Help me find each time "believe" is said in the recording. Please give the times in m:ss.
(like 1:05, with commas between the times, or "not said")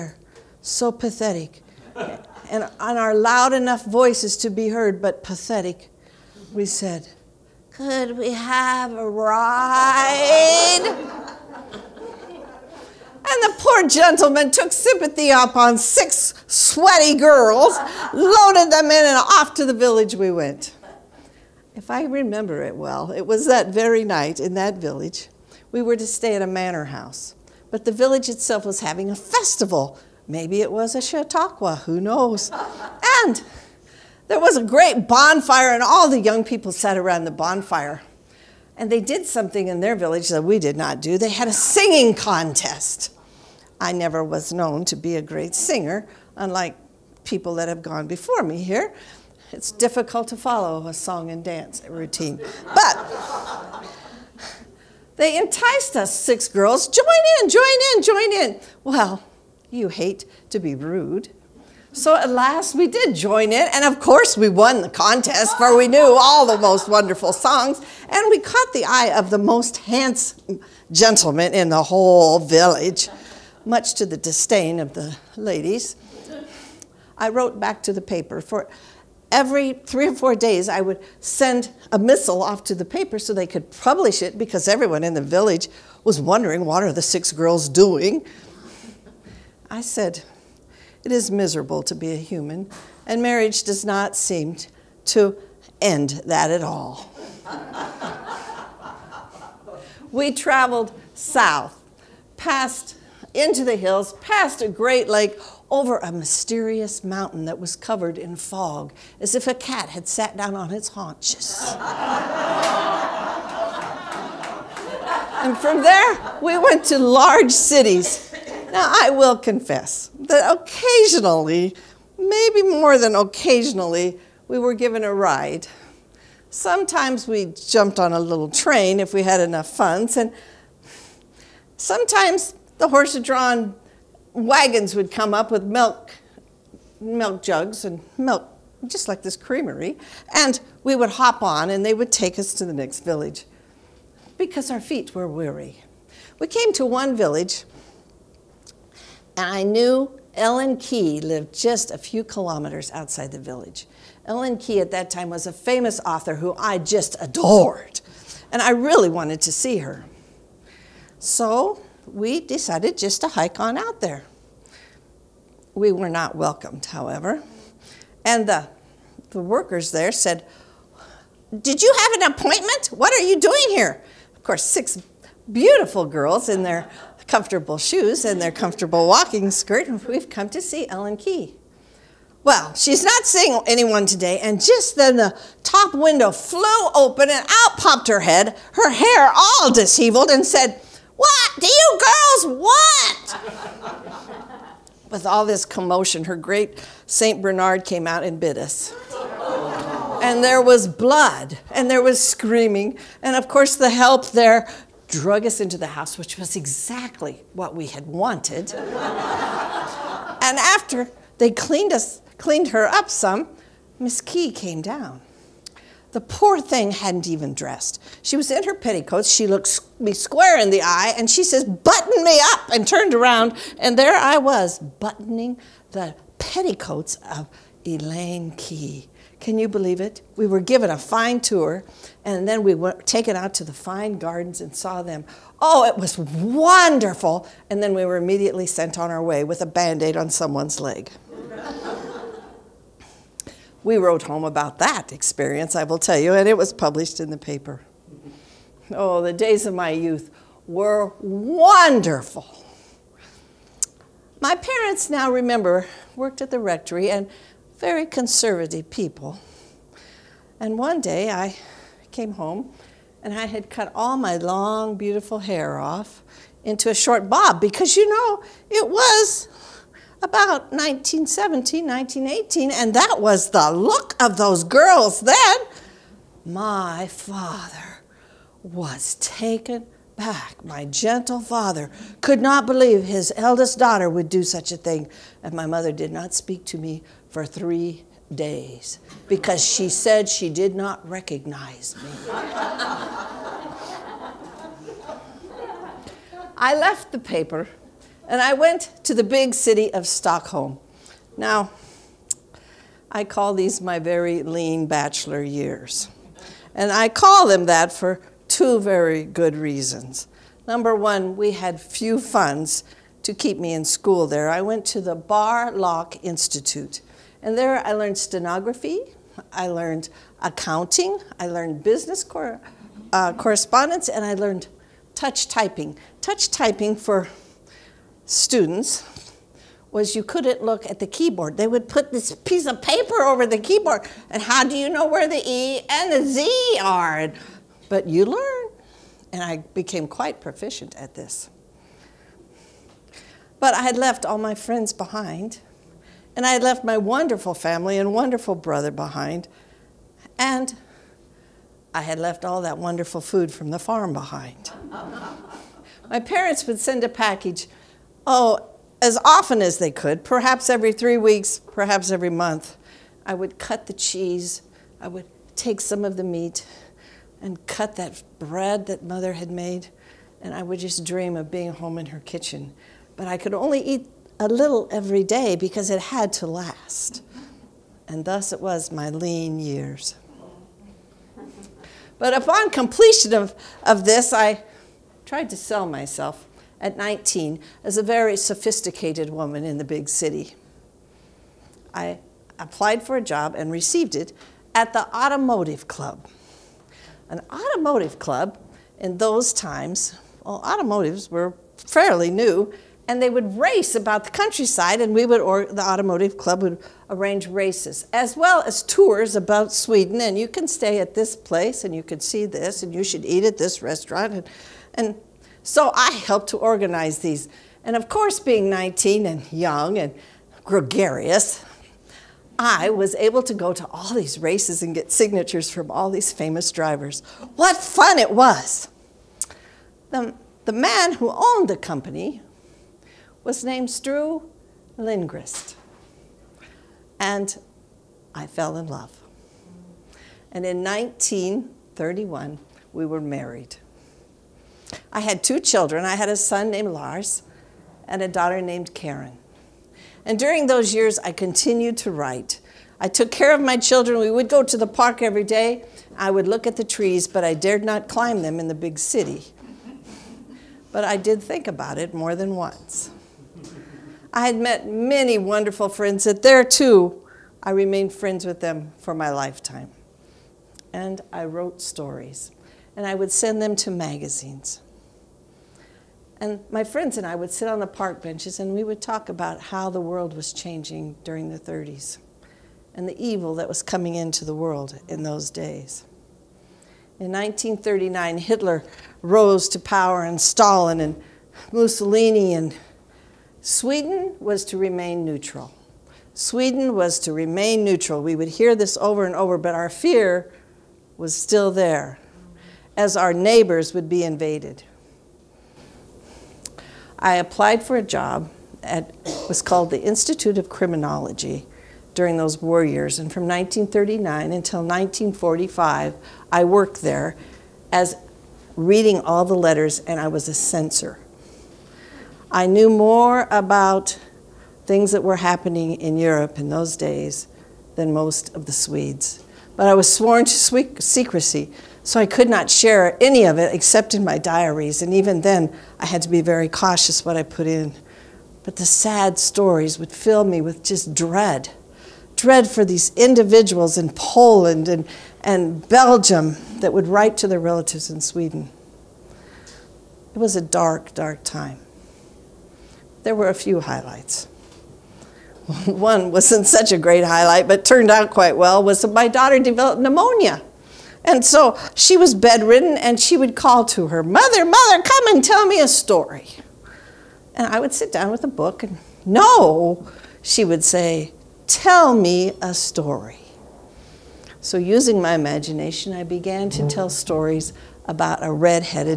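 3:49, 4:42.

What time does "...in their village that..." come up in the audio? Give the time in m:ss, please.
0:39.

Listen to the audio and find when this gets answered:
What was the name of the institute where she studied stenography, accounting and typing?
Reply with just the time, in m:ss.
5:15.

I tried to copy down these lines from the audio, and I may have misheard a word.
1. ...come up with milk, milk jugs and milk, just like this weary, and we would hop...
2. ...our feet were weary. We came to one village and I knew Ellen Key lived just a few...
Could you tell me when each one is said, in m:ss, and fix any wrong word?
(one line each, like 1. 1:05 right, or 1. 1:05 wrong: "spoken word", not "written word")
1. 2:15 wrong: "creamery", not "weary"
2. 2:24 right.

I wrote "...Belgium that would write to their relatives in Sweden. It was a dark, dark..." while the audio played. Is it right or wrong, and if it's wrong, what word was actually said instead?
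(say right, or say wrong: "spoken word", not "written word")
right.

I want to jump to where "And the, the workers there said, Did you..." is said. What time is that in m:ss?
2:48.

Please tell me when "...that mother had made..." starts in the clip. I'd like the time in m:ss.
6:08.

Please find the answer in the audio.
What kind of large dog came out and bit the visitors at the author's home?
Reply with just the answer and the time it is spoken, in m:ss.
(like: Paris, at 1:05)
St. Bernard, at 3:17.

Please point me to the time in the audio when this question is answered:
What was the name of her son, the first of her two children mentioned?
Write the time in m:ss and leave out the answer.
7:26.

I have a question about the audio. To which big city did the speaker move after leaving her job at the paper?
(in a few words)
Stockholm.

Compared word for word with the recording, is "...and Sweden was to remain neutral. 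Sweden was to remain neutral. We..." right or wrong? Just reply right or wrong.
right.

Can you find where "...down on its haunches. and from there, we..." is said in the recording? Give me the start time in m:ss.
1:50.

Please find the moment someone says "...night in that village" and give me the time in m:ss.
0:24.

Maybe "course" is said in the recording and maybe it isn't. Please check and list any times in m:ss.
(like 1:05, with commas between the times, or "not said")
1:03, 2:54, 3:23, 6:58.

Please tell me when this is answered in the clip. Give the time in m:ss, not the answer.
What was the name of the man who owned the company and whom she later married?
7:13.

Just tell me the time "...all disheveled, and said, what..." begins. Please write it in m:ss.
3:09.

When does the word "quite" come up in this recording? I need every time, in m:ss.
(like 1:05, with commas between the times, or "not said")
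5:40, 9:18.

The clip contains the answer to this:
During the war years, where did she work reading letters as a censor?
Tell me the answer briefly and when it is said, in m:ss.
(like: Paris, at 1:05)
Institute of Criminology, at 8:30.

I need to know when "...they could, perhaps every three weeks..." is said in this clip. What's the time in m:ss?
5:59.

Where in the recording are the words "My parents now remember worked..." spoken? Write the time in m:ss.
4:14.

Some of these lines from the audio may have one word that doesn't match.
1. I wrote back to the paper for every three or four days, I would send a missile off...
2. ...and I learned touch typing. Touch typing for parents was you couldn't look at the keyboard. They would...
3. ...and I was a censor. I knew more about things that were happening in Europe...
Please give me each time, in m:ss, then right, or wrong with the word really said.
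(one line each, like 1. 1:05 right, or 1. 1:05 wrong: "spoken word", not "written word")
1. 1:17 right
2. 5:24 wrong: "students", not "parents"
3. 8:39 right.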